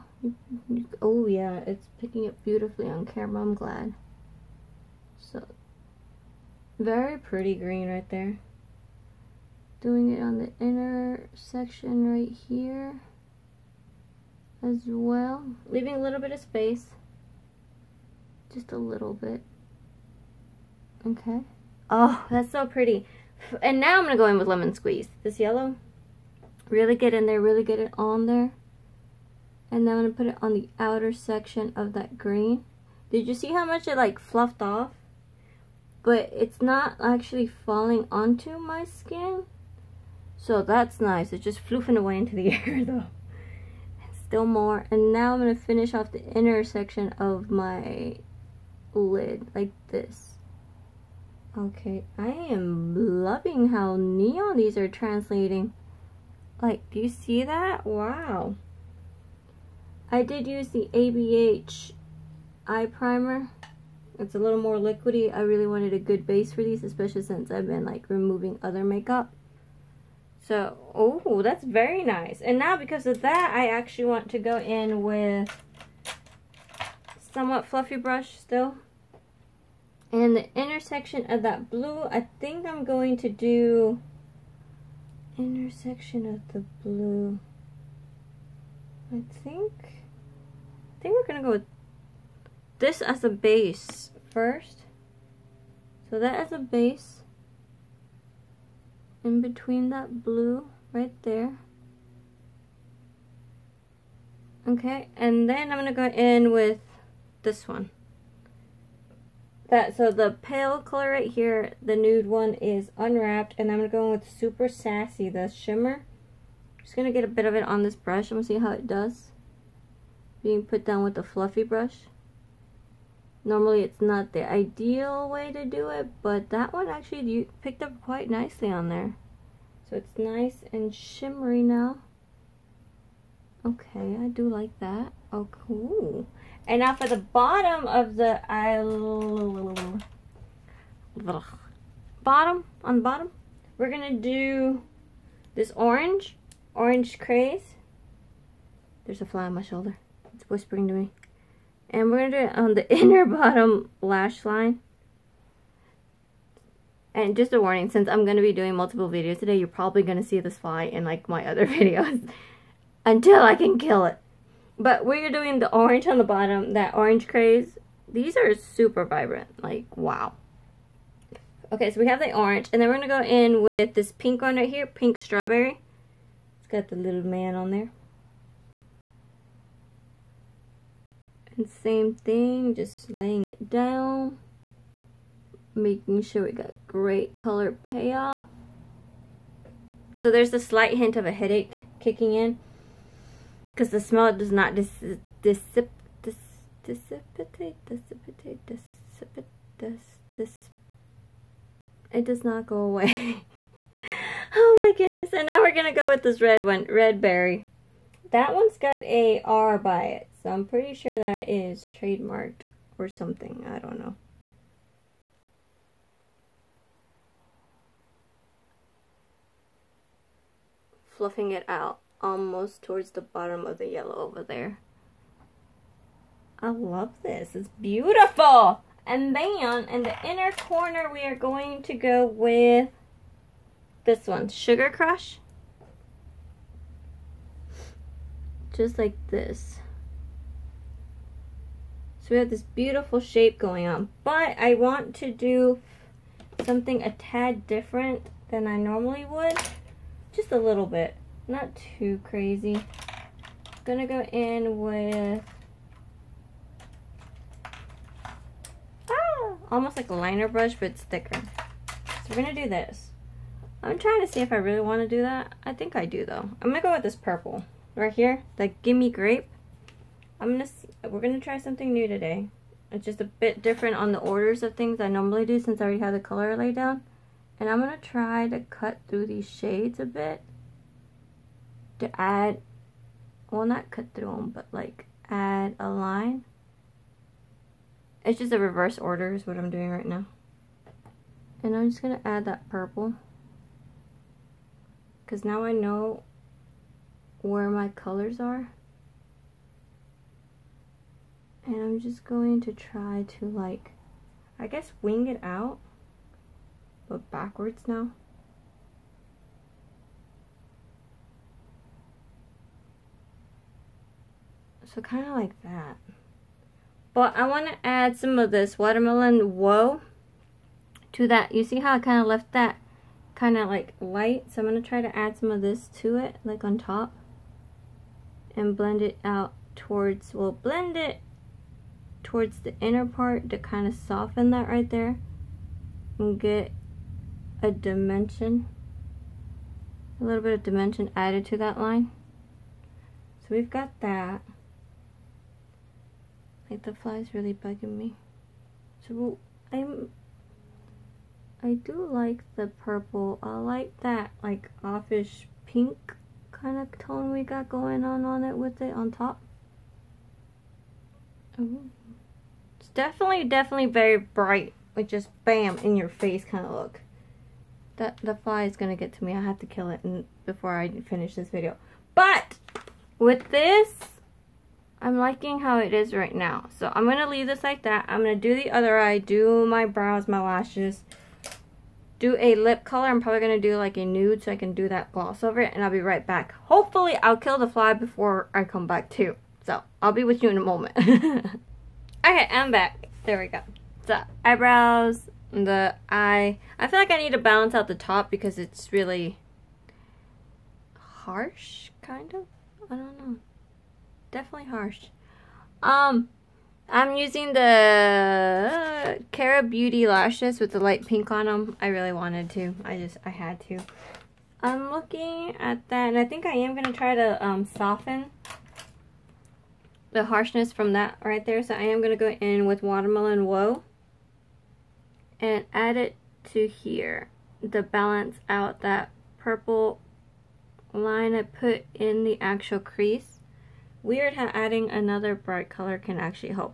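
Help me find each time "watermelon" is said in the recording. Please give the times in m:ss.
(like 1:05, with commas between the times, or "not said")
5:18, 7:02.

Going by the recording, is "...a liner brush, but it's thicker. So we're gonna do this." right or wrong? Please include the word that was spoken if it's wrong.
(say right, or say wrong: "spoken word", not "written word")
right.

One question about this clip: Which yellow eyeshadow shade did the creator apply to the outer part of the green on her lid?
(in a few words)
Lemon Squeeze.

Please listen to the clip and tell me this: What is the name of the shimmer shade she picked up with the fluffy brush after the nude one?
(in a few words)
Super Sassy.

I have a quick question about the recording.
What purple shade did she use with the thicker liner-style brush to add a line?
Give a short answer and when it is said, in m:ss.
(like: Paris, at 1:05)
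Gimme Grape, at 4:28.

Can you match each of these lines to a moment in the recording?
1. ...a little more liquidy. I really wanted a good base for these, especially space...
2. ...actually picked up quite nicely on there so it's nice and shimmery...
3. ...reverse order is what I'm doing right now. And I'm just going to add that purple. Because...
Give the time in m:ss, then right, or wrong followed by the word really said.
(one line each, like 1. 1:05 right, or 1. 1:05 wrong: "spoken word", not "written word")
1. 1:04 wrong: "since", not "space"
2. 2:06 right
3. 4:48 right.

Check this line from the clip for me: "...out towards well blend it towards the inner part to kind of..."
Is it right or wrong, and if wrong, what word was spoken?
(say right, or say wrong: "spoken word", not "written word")
right.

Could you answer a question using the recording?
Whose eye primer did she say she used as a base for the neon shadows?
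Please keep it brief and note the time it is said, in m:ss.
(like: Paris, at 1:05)
ABH, at 1:00.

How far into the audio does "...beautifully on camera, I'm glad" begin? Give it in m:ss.
0:02.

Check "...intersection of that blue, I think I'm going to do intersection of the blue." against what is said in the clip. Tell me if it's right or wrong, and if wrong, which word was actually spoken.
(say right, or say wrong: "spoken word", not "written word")
right.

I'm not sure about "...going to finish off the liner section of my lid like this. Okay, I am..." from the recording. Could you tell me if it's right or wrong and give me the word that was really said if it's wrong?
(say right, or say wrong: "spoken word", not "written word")
wrong: "inner", not "liner".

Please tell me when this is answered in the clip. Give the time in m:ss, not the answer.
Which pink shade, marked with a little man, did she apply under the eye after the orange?
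2:54.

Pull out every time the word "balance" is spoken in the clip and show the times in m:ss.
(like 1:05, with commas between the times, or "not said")
6:37, 7:07.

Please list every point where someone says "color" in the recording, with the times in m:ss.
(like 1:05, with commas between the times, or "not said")
1:50, 3:07, 4:36, 4:57, 6:22, 7:15.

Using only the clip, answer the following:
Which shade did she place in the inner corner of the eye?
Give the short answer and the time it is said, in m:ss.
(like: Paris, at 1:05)
Sugar Crush, at 3:54.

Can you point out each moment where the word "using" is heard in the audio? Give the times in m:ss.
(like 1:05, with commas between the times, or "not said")
6:47.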